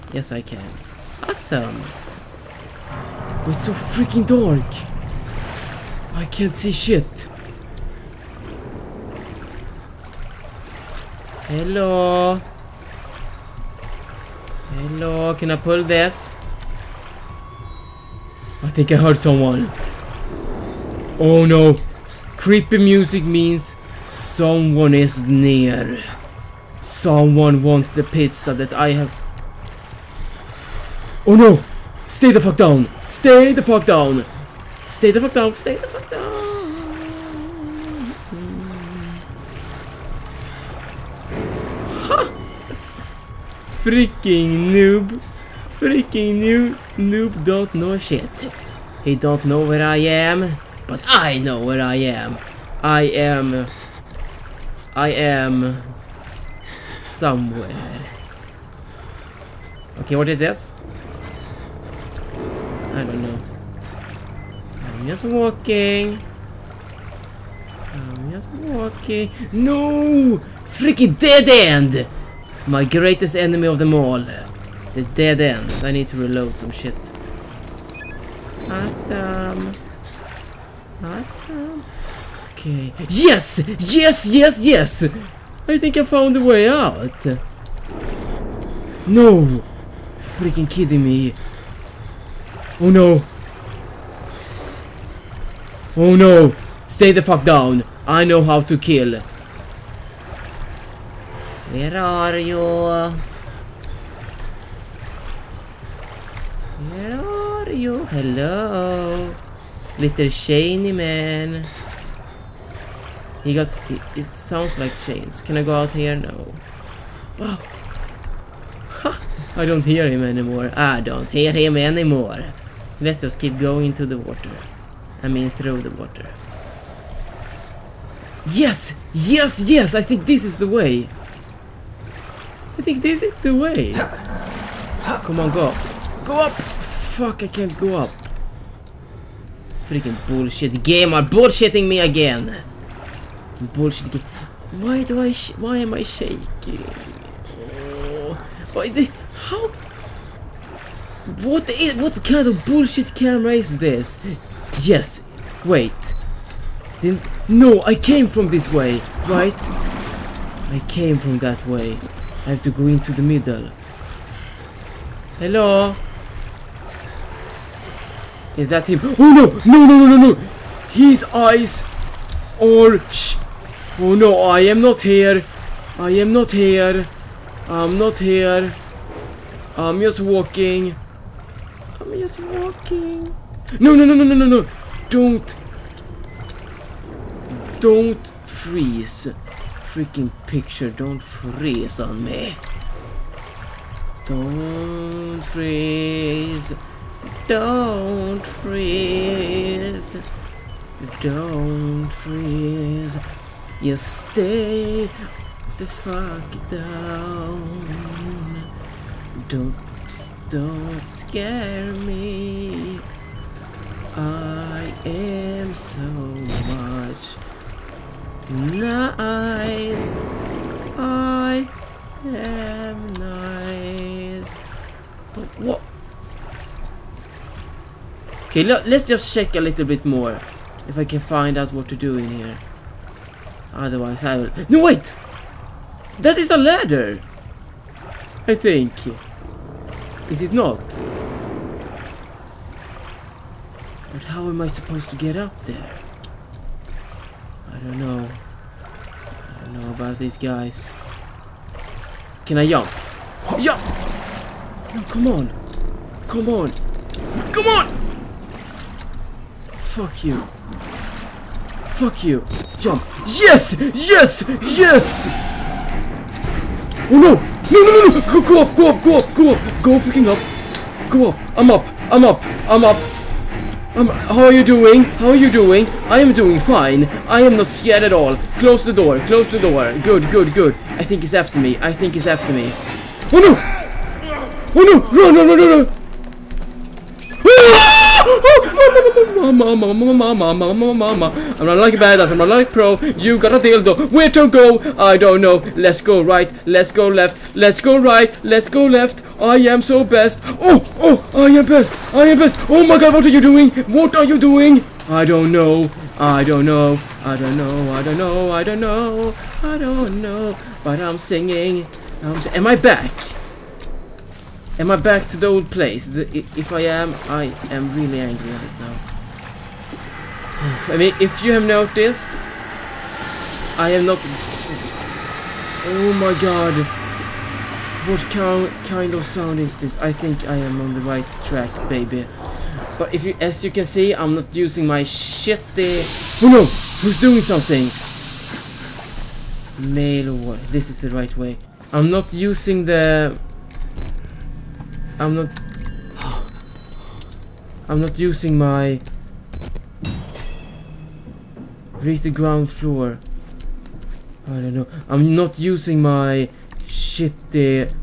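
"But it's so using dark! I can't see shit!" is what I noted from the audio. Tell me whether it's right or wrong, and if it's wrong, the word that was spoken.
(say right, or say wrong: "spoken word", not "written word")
wrong: "freaking", not "using".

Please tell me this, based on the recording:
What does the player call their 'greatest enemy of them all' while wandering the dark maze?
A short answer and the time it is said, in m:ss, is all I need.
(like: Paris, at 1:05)
Dead ends, at 1:14.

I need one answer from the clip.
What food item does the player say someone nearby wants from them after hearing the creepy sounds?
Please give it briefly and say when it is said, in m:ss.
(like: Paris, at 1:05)
Pizza, at 0:28.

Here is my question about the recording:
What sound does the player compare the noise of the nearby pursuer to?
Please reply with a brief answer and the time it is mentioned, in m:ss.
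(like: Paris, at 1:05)
Chains, at 1:55.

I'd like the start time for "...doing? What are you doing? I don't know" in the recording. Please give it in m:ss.
5:03.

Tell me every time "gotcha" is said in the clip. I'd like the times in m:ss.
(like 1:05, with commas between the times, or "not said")
not said.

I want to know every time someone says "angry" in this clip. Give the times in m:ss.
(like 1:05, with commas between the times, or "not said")
5:18.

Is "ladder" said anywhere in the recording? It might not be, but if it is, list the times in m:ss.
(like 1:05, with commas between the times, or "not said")
3:56.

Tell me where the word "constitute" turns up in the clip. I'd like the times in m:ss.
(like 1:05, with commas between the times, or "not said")
not said.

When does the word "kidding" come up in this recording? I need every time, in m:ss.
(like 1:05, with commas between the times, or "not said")
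1:30.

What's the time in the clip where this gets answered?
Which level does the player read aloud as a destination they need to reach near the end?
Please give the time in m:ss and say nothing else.
5:52.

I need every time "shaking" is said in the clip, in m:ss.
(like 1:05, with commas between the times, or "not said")
2:26.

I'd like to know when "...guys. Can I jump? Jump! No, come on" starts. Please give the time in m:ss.
4:10.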